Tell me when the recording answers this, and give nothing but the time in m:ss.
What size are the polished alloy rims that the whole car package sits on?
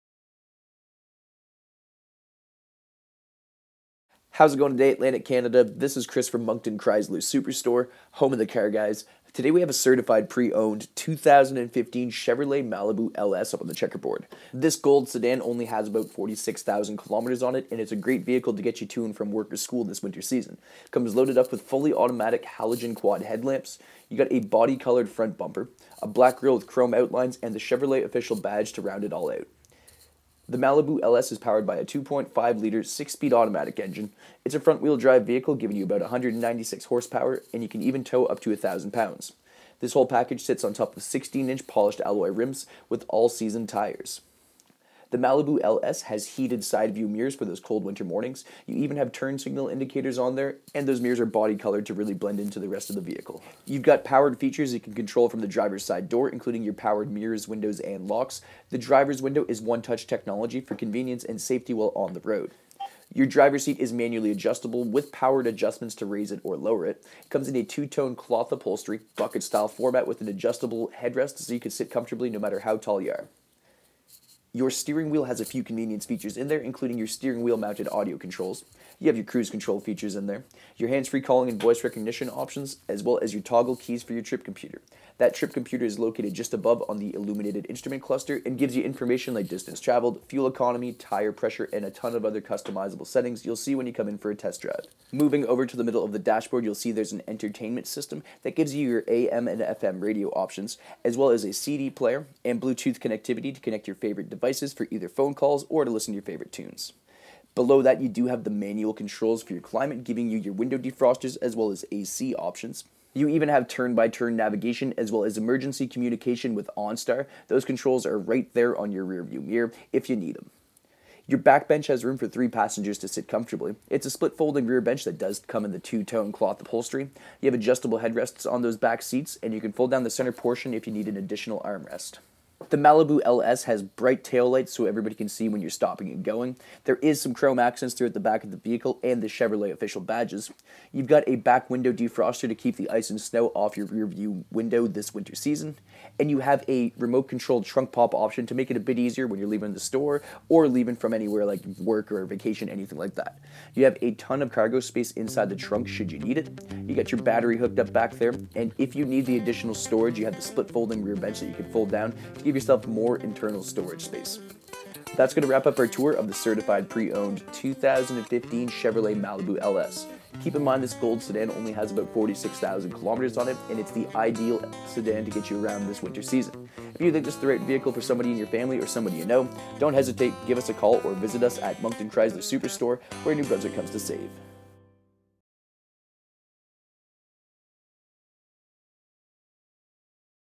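0:41.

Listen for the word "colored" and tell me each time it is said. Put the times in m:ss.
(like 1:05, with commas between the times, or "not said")
0:24, 0:51.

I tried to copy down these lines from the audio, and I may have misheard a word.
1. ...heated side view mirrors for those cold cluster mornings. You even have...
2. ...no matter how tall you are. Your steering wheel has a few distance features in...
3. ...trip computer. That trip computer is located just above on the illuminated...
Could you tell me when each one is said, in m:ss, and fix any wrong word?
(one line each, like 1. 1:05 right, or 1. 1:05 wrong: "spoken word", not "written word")
1. 0:46 wrong: "winter", not "cluster"
2. 1:12 wrong: "convenience", not "distance"
3. 1:24 right.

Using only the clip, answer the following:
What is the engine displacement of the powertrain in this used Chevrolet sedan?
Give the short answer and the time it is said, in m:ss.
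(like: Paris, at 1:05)
2.5 liters, at 0:31.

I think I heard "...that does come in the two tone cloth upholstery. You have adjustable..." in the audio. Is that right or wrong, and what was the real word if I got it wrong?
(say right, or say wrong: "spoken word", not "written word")
right.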